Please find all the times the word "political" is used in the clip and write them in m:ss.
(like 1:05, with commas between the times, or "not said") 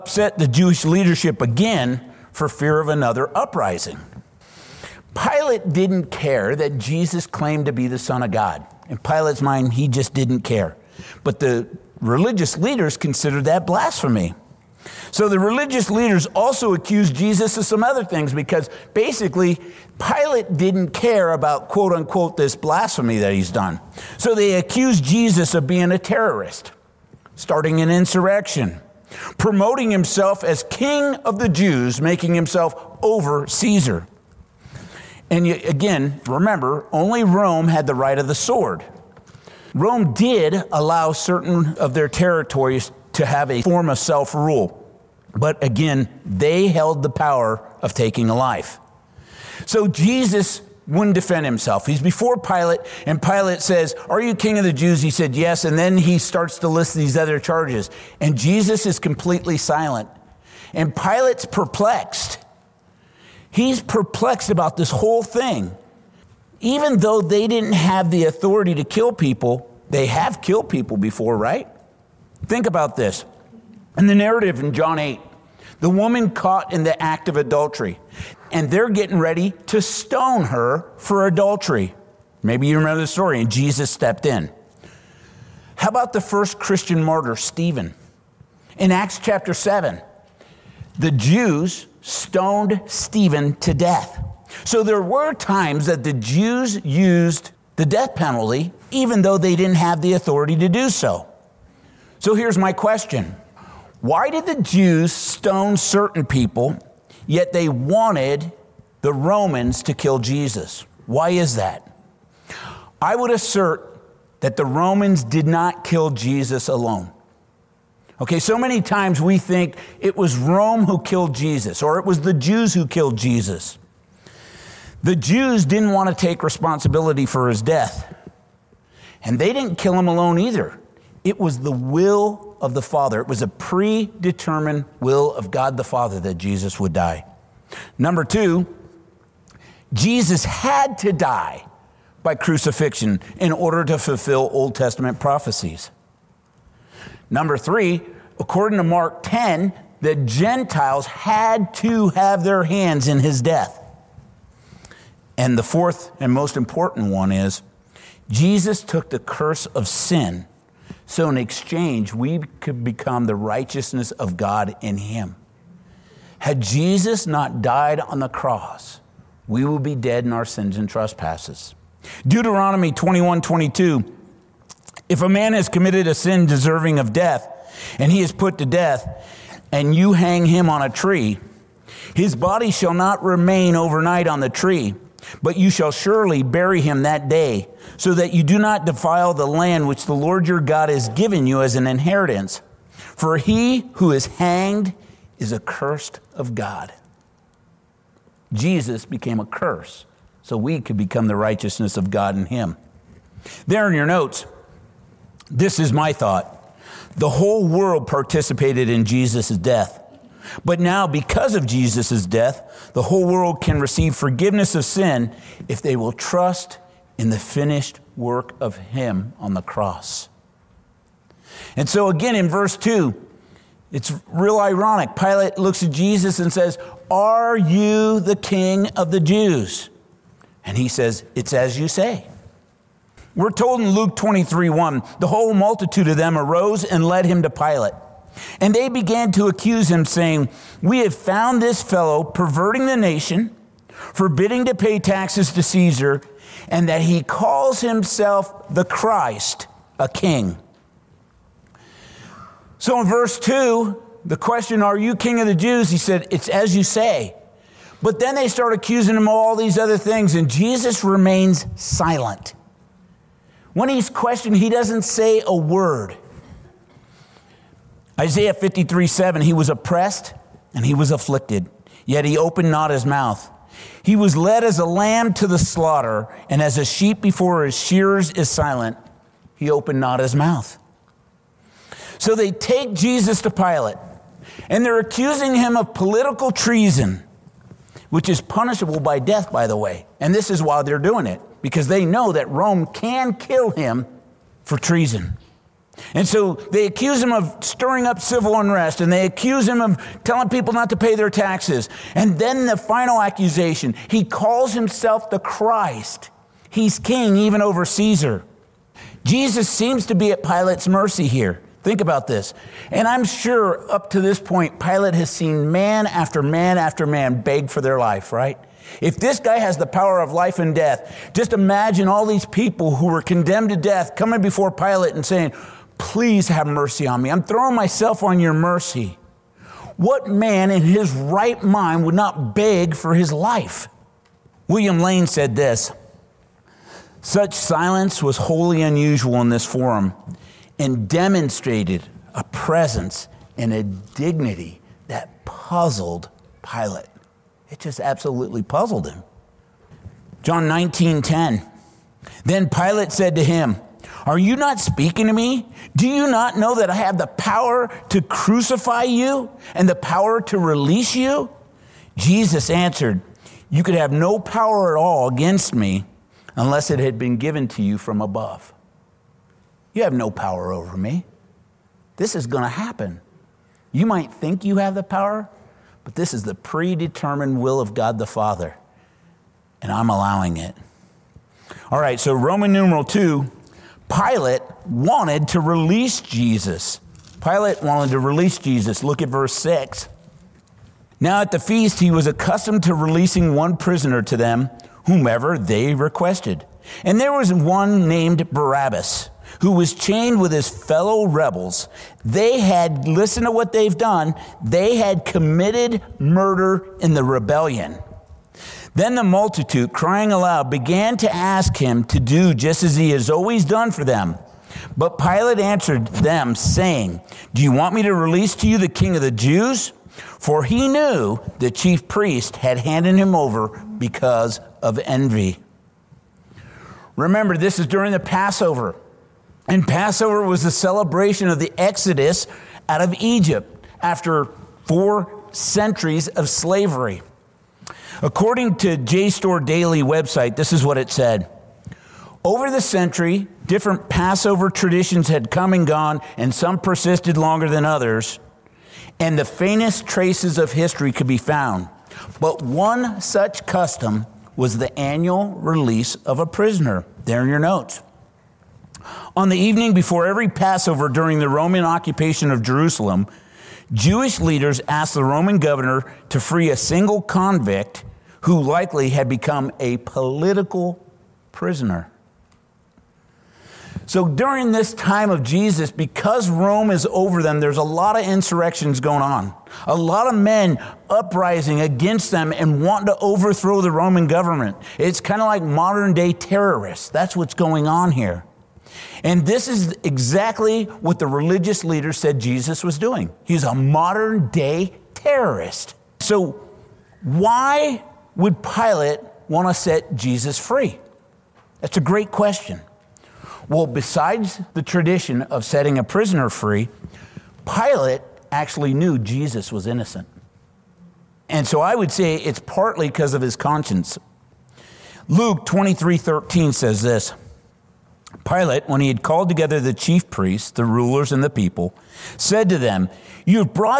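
4:45, 7:49.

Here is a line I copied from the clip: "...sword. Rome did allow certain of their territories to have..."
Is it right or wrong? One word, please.
right.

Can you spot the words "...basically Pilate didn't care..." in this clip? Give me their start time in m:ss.
0:18.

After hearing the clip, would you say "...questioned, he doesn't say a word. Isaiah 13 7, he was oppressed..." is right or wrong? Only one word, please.
wrong.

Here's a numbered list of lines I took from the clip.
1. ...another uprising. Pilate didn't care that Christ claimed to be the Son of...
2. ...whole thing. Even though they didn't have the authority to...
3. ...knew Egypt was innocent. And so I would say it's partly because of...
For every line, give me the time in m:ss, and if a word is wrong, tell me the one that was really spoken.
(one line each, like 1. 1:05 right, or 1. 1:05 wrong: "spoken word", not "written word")
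1. 0:02 wrong: "Jesus", not "Christ"
2. 1:04 right
3. 8:28 wrong: "Jesus", not "Egypt".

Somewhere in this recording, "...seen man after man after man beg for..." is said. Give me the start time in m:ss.
5:15.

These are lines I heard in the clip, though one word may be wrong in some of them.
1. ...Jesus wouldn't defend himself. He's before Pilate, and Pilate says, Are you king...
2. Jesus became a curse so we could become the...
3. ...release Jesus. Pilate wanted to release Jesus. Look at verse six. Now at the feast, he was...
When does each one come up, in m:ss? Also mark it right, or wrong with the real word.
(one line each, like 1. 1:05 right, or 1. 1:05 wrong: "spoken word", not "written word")
1. 0:49 right
2. 3:18 right
3. 6:25 right.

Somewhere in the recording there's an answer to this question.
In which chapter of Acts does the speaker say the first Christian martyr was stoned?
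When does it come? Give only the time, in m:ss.
1:28.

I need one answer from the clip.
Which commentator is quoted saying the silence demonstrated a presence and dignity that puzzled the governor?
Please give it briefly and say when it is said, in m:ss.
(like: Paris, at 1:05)
William Lane, at 5:34.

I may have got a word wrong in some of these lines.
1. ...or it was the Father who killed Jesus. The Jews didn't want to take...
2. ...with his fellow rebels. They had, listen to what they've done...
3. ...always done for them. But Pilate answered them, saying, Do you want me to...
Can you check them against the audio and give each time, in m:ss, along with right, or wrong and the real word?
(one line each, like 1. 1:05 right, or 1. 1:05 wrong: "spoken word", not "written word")
1. 2:01 wrong: "Jews", not "Father"
2. 6:40 right
3. 6:53 right.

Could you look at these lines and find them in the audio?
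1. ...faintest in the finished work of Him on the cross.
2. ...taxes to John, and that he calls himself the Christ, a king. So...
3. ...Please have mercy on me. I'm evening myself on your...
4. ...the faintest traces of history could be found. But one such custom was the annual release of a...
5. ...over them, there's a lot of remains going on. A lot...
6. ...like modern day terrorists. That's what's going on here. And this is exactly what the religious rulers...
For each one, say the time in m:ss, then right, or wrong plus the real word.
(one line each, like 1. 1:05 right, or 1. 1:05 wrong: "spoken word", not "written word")
1. 3:36 wrong: "trust", not "faintest"
2. 4:04 wrong: "Caesar", not "John"
3. 5:25 wrong: "throwing", not "evening"
4. 7:29 right
5. 7:57 wrong: "insurrections", not "remains"
6. 8:05 wrong: "leaders", not "rulers".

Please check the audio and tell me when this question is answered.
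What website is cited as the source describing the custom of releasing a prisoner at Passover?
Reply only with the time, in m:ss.
7:18.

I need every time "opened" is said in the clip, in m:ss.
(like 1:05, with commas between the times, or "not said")
4:32, 4:39.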